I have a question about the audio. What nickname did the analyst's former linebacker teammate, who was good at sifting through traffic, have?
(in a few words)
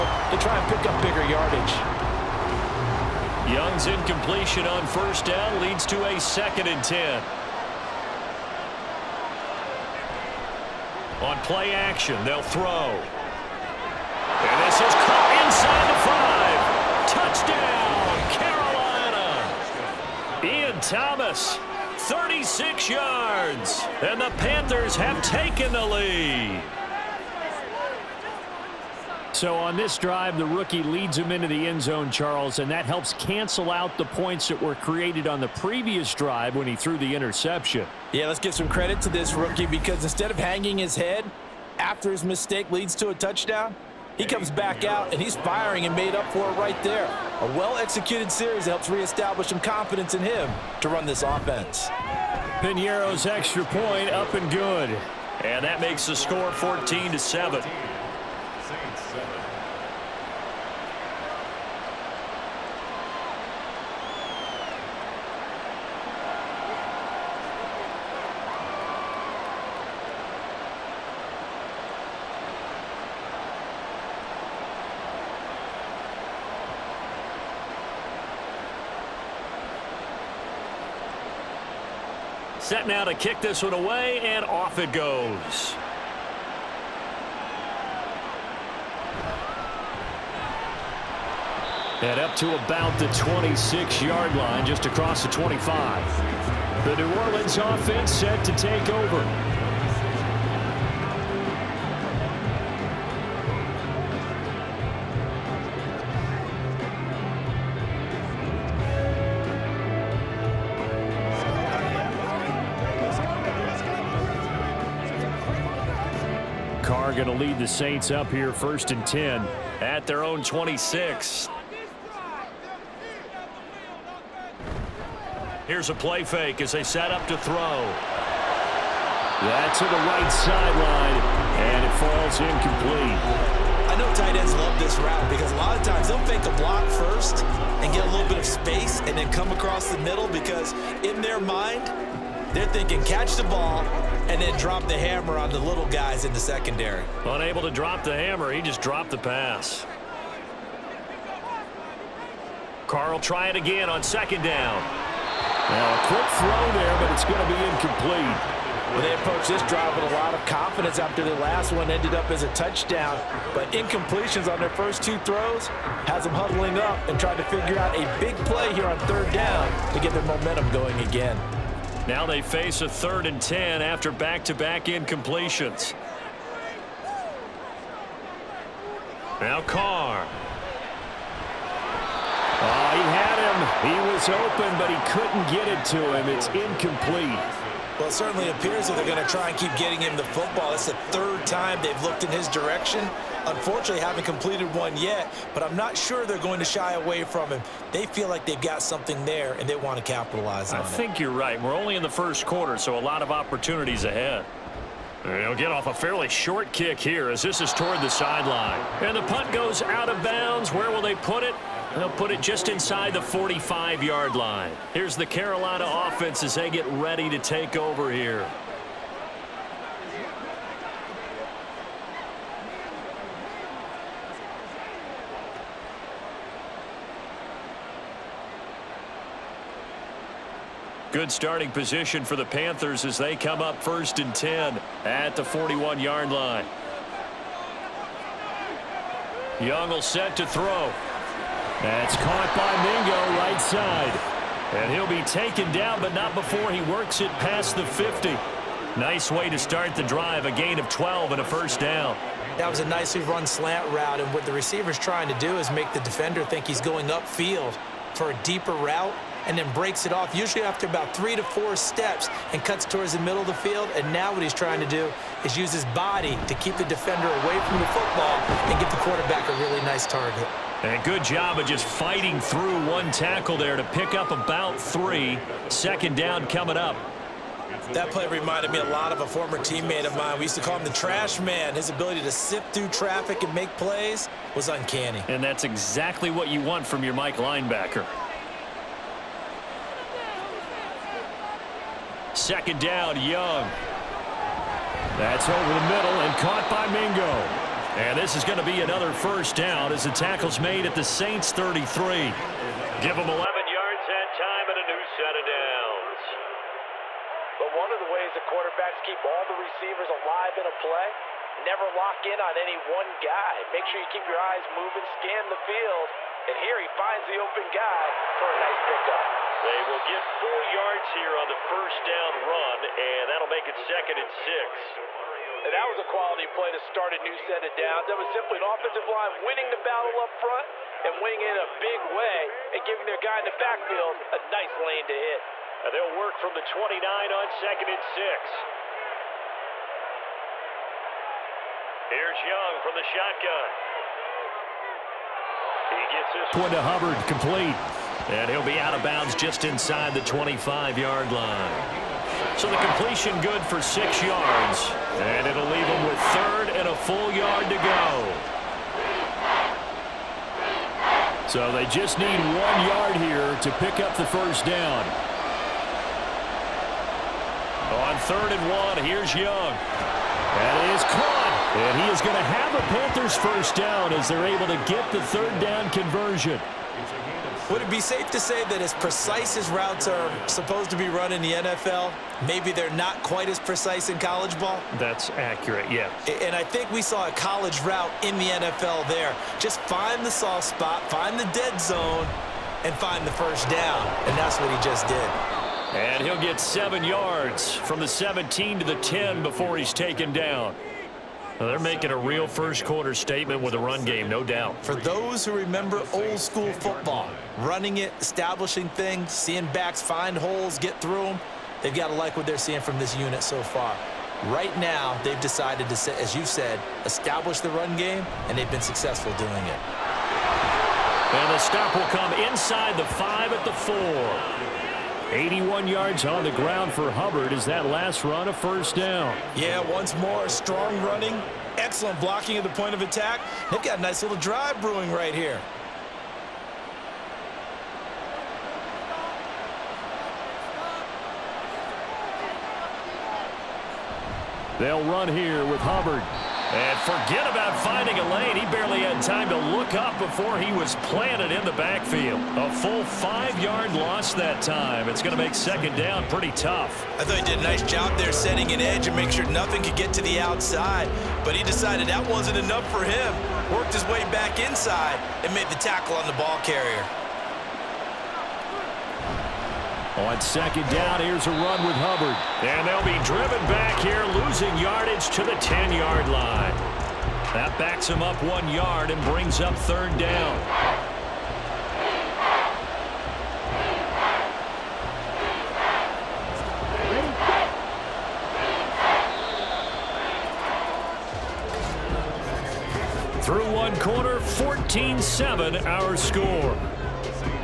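The trash man.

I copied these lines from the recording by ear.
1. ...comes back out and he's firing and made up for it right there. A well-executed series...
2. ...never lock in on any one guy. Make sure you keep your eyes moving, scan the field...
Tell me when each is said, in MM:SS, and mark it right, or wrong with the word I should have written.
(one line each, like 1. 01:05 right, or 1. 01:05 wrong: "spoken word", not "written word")
1. 00:44 right
2. 05:11 right.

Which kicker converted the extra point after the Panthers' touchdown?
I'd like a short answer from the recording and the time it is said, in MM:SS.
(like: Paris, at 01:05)
Piñeiro, at 00:52.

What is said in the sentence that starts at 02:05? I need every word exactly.
Here's a play fake as they set up to throw.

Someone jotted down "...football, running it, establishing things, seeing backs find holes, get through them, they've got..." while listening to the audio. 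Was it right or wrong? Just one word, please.
right.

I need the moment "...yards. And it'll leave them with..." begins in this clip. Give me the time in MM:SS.
05:54.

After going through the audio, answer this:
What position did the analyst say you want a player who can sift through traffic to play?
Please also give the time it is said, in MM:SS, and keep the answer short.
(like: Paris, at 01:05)
Mike linebacker, at 04:47.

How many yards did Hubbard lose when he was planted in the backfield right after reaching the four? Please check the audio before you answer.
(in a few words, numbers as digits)
5.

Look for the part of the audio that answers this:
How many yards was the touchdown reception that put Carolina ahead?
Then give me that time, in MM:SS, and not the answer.
00:22.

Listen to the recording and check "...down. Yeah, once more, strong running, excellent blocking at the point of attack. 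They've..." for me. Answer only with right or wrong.
right.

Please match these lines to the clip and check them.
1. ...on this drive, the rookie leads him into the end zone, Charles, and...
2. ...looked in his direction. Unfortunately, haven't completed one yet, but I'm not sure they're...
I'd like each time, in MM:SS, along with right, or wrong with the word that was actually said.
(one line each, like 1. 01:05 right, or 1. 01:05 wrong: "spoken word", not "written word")
1. 00:29 right
2. 03:12 right.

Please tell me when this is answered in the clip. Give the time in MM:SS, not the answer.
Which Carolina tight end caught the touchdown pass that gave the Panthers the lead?
00:20.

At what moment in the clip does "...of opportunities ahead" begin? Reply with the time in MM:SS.
03:23.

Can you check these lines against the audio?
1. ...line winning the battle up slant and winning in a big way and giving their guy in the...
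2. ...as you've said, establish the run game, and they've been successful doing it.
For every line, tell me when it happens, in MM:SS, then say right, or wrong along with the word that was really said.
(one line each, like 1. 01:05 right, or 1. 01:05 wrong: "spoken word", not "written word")
1. 05:29 wrong: "front", not "slant"
2. 06:56 right.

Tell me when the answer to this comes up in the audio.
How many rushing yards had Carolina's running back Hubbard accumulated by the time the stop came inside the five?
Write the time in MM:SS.
07:05.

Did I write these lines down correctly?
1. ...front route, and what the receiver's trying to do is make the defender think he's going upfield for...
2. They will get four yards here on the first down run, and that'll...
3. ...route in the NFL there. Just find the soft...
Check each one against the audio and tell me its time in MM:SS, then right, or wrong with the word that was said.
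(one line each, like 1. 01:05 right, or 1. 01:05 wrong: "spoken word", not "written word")
1. 04:13 wrong: "slant", not "front"
2. 05:19 right
3. 06:27 right.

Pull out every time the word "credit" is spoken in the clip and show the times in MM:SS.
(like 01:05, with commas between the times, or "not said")
00:38.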